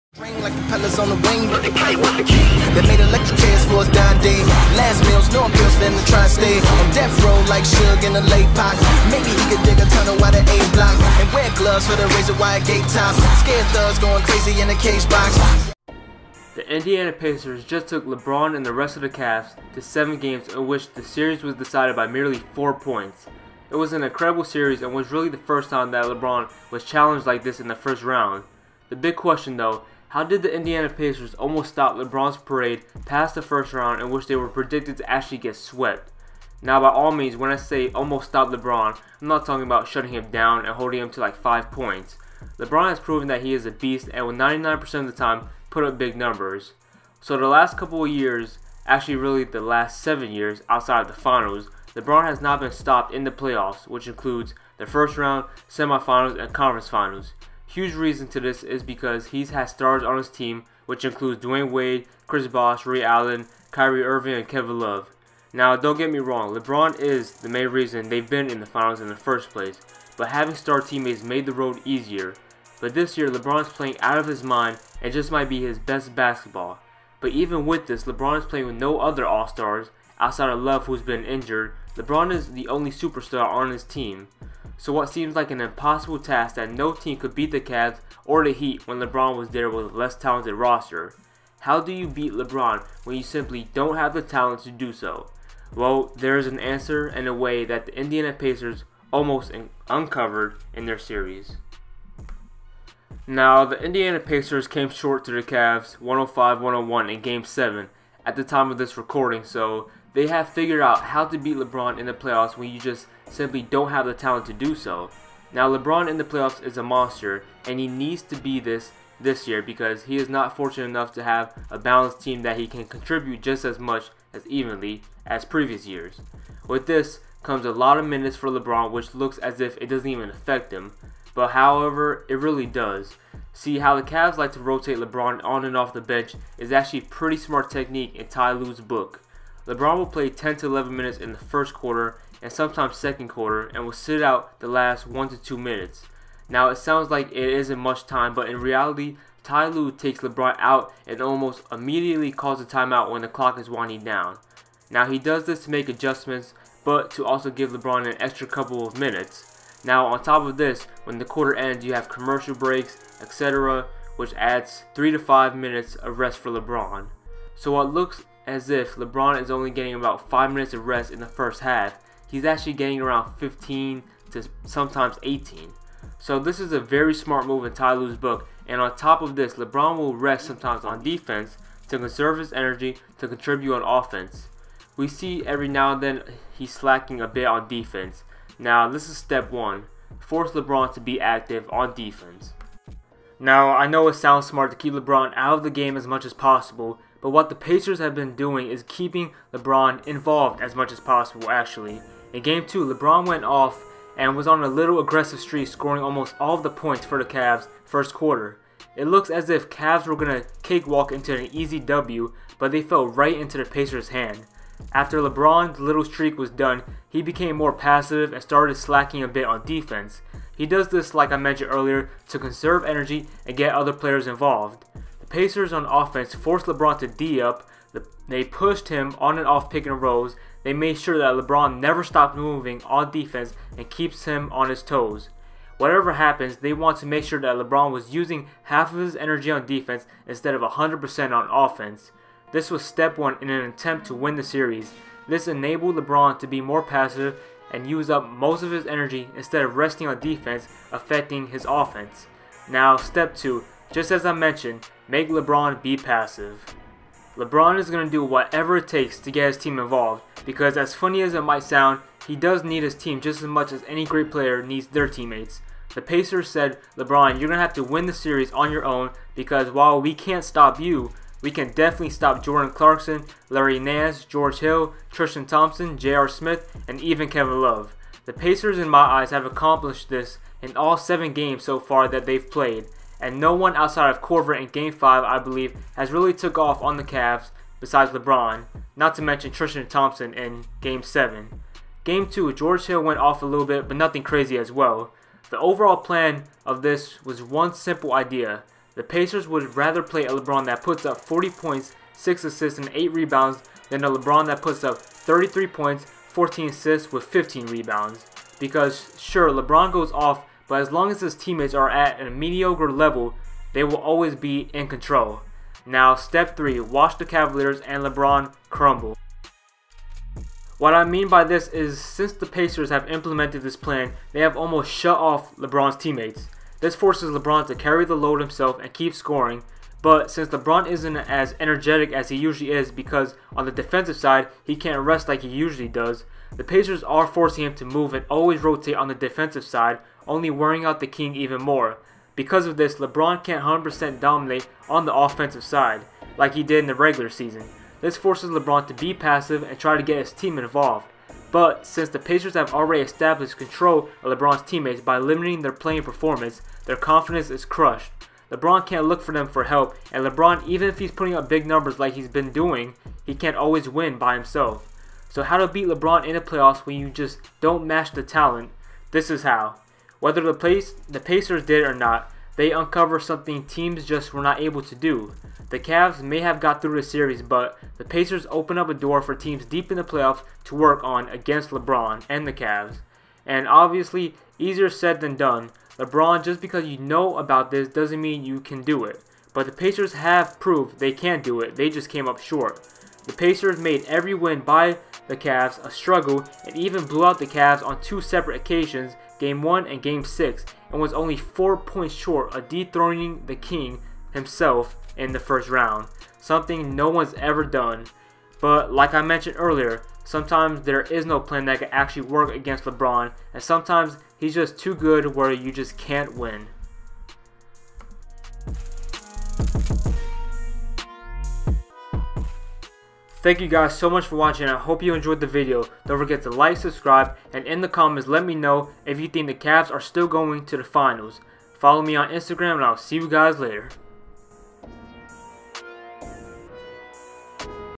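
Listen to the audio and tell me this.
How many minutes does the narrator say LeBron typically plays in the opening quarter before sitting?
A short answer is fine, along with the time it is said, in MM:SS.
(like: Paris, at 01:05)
10 to 11, at 02:20.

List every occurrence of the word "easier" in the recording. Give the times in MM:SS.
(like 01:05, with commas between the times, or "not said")
01:11, 06:24.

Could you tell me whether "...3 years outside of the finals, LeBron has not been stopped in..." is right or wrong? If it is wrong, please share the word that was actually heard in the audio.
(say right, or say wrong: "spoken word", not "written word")
wrong: "7", not "3".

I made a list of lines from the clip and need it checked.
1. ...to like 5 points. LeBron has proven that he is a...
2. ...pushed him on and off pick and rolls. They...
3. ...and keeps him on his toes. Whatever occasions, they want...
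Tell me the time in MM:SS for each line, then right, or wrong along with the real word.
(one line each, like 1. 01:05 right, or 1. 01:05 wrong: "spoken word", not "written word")
1. 00:41 right
2. 03:48 right
3. 03:53 wrong: "happens", not "occasions".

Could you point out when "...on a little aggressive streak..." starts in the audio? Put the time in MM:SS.
03:24.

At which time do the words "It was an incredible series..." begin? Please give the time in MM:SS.
00:23.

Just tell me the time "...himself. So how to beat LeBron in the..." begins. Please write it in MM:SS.
06:04.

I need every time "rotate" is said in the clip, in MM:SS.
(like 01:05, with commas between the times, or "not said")
02:14, 05:38.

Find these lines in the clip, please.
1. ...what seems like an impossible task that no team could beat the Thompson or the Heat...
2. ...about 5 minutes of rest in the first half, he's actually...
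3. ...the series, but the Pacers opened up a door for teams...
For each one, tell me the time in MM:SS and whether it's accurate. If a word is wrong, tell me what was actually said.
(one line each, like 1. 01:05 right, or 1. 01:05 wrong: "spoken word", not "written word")
1. 01:24 wrong: "Cavs", not "Thompson"
2. 02:49 right
3. 06:16 right.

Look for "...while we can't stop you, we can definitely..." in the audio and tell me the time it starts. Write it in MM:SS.
04:29.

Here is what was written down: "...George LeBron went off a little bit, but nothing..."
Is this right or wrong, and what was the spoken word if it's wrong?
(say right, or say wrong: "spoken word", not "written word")
wrong: "Hill", not "LeBron".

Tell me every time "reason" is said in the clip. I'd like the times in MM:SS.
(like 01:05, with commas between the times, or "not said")
00:57, 01:07.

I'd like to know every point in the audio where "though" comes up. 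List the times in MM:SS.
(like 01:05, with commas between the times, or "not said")
00:29.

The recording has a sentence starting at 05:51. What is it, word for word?
But since the Pacers have already established control of LeBron's teammates by limiting their playing performance, their confidence is crushed.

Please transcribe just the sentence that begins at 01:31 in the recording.
How do you beat LeBron when you simply don't have the talent to do so?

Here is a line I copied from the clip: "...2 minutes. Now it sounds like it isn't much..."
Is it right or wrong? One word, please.
right.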